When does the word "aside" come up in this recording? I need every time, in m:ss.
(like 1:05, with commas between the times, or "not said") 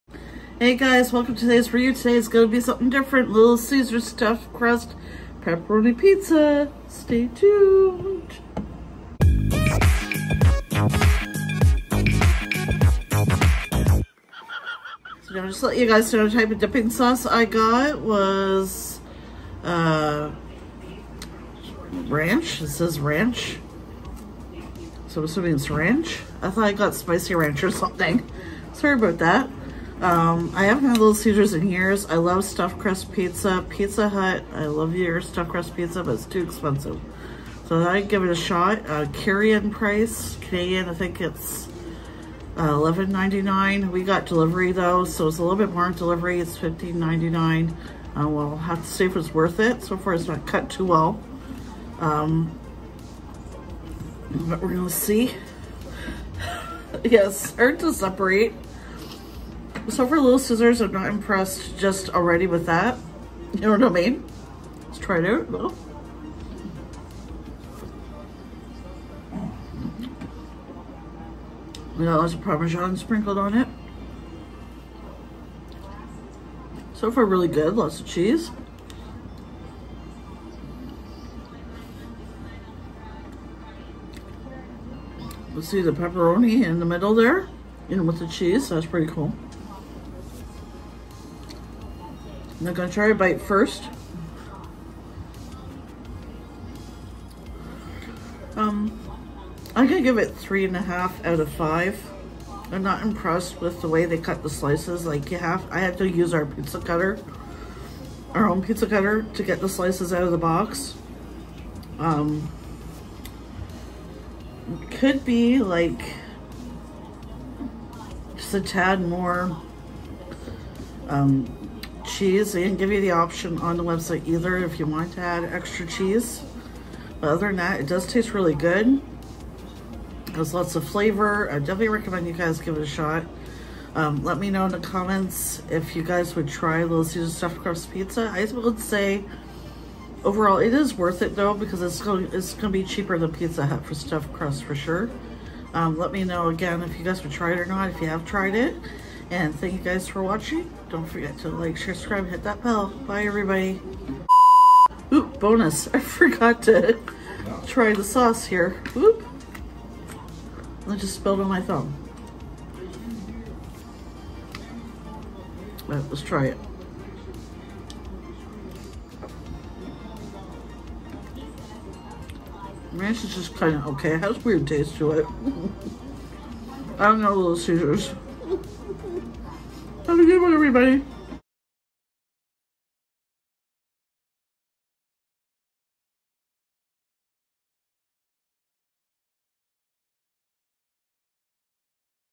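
not said.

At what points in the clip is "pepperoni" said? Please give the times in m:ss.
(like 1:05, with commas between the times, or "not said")
0:05, 1:25.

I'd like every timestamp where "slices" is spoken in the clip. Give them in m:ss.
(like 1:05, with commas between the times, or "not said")
1:44, 1:49.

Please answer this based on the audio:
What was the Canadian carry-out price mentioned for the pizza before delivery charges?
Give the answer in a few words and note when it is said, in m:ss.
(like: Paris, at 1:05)
$11.99, at 0:42.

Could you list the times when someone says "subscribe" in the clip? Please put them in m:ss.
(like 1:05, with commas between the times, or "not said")
2:31.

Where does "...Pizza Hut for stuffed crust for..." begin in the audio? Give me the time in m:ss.
2:23.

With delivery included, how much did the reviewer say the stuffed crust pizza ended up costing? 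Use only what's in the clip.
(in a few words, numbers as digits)
$15.99.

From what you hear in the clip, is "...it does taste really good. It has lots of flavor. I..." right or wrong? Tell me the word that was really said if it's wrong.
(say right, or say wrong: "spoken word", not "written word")
right.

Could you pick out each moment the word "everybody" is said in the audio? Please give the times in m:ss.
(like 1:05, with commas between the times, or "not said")
2:33, 3:00.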